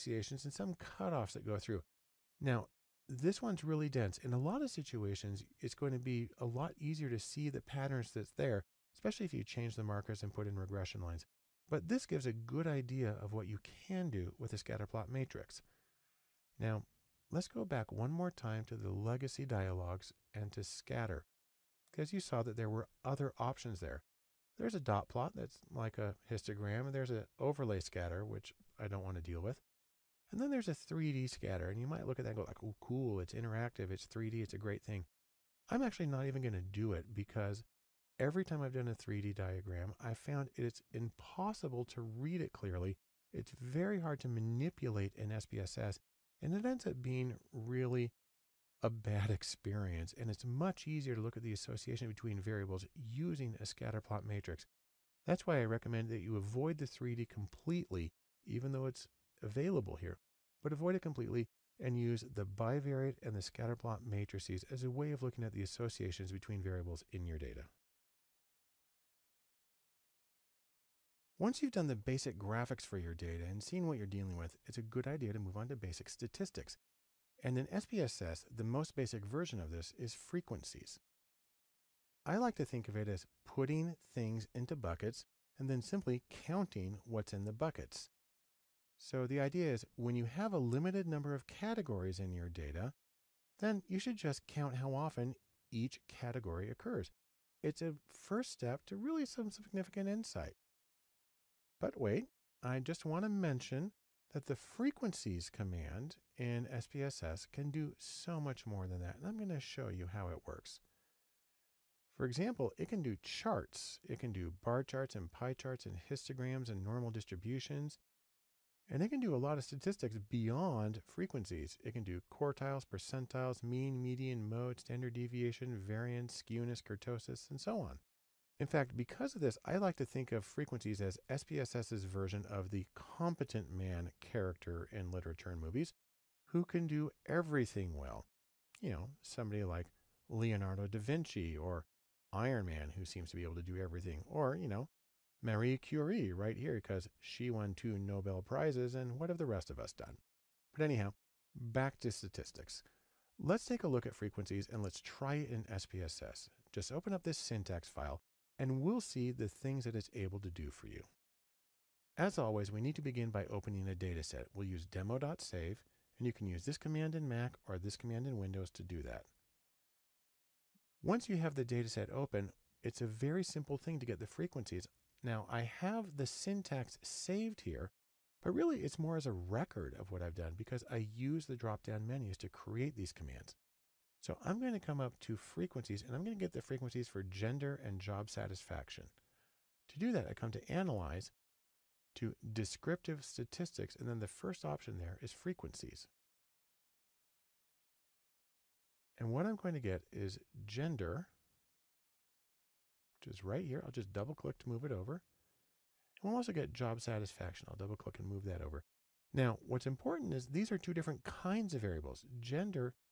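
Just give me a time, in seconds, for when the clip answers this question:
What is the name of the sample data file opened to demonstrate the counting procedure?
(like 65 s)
164 s.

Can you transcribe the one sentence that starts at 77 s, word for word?
And in SPSS, the most basic version of this is frequencies.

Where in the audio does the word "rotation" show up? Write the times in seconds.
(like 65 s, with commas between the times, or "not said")
not said.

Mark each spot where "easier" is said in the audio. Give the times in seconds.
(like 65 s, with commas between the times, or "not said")
6 s, 50 s.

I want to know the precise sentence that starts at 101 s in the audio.
But wait, I just want to mention that the frequencies command in SPSS can do so much more than that.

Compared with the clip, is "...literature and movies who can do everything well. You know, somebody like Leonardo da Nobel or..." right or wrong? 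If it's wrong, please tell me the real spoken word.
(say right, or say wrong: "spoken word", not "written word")
wrong: "Vinci", not "Nobel".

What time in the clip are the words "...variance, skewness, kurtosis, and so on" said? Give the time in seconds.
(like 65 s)
125 s.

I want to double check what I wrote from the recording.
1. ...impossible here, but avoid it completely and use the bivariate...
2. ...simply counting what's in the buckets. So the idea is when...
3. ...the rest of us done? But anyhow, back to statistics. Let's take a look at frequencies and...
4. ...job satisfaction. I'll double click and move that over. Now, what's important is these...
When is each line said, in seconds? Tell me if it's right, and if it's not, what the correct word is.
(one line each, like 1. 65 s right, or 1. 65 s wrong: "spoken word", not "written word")
1. 59 s wrong: "available", not "impossible"
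2. 85 s right
3. 149 s right
4. 206 s right.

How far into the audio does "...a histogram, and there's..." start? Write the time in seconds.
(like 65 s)
25 s.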